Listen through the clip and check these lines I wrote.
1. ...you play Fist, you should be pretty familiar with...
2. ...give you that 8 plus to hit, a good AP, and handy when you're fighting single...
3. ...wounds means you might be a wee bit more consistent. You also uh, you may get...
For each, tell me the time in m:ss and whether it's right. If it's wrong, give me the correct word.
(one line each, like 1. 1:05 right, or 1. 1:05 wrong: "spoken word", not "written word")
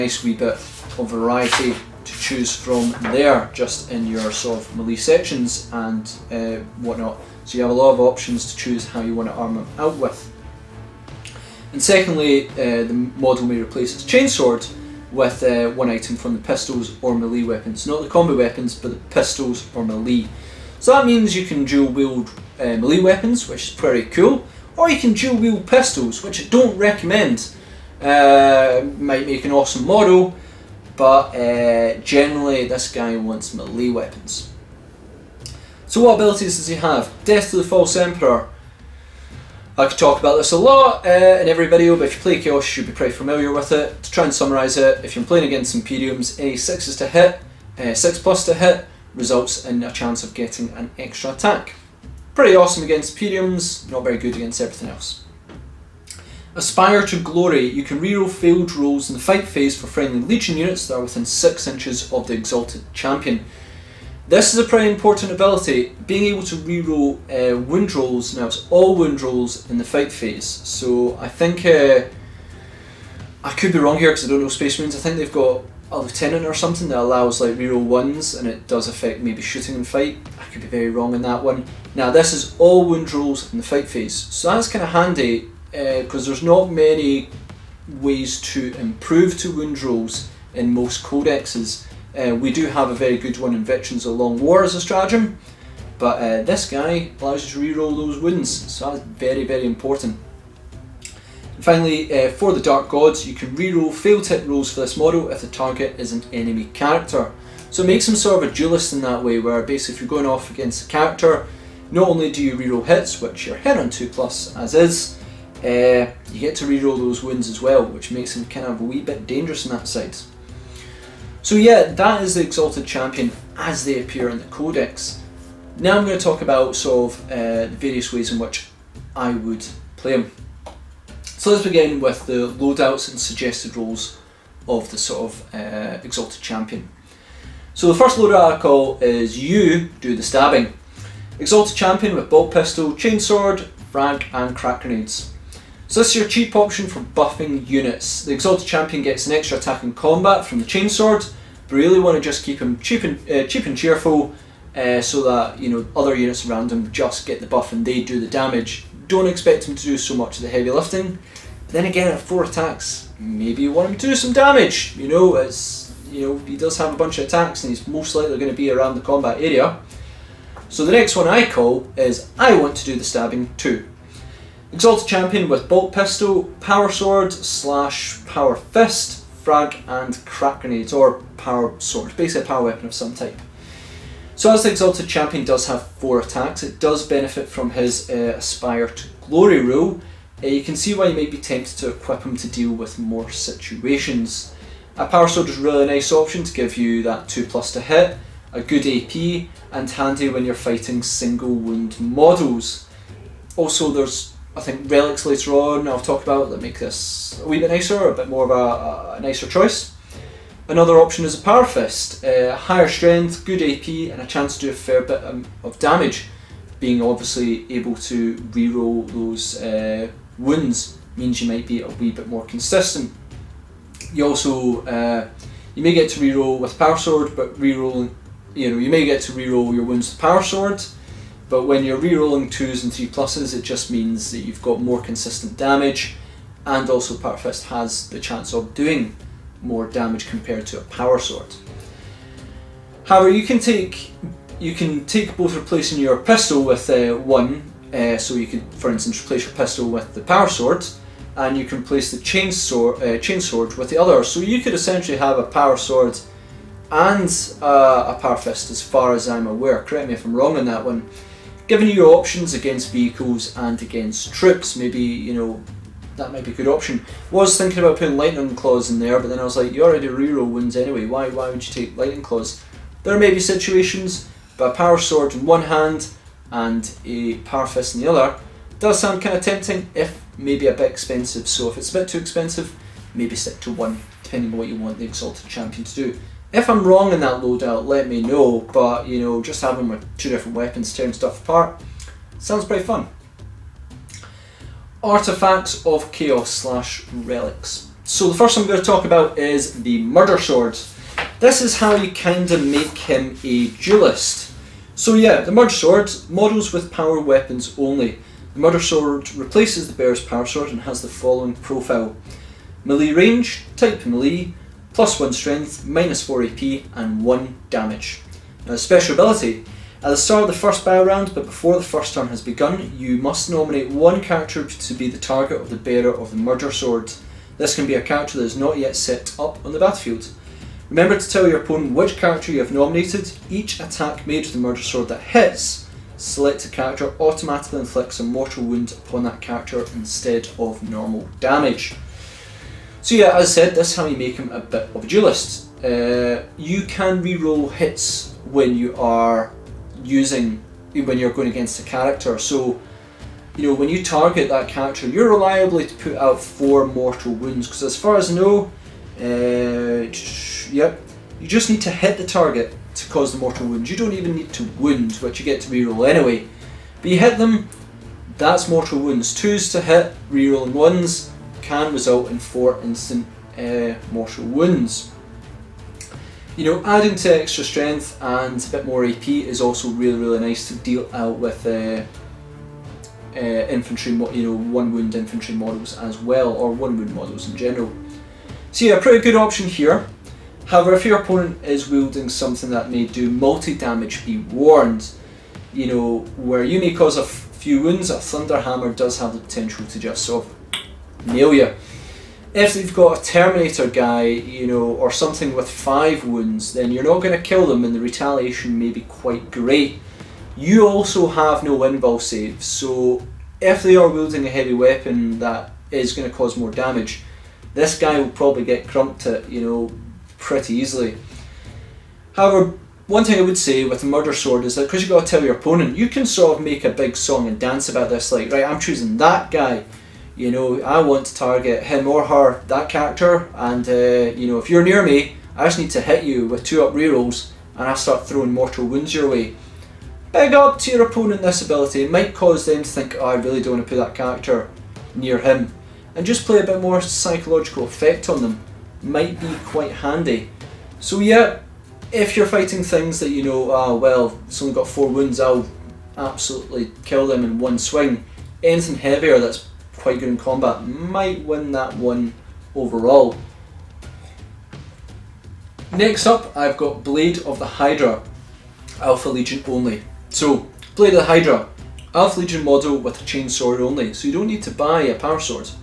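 1. 0:42 wrong: "Chaos", not "Fist"
2. 3:16 wrong: "2", not "8"
3. 3:40 right.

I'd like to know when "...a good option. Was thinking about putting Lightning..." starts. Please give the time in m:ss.
4:26.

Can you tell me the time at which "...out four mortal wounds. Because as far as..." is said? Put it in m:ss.
5:56.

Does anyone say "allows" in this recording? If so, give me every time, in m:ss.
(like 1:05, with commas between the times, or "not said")
1:16, 1:37.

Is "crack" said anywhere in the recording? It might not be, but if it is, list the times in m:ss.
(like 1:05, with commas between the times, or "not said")
2:24, 3:00.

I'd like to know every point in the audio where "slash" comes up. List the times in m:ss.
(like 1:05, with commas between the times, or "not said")
2:57, 4:56.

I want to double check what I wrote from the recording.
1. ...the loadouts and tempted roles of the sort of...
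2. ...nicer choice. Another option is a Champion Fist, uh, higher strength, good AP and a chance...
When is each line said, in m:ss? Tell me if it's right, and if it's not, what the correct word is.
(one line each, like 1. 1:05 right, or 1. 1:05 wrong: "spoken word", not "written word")
1. 2:12 wrong: "suggested", not "tempted"
2. 3:29 wrong: "Power", not "Champion".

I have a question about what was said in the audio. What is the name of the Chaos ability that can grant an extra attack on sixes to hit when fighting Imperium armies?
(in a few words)
Death to the False Emperor.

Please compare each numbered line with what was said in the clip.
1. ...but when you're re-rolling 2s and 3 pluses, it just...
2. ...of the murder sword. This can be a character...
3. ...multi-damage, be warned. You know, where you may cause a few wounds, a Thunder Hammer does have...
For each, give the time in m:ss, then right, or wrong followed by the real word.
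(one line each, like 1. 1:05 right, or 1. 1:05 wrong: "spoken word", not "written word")
1. 3:51 right
2. 5:26 right
3. 6:33 right.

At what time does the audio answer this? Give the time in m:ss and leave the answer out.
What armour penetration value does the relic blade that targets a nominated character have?
5:15.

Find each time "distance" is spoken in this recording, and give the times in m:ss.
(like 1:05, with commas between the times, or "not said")
not said.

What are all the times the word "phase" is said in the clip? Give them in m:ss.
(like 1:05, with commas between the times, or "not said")
0:59, 1:10, 1:23.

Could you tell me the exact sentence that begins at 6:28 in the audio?
So yeah, a pretty good option here.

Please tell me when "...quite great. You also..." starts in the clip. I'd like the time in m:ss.
6:49.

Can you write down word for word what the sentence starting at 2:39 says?
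Don't expect him to do so much of the heavy lifting.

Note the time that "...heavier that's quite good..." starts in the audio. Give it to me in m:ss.
7:38.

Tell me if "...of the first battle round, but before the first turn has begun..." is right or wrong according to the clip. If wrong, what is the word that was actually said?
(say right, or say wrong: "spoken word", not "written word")
right.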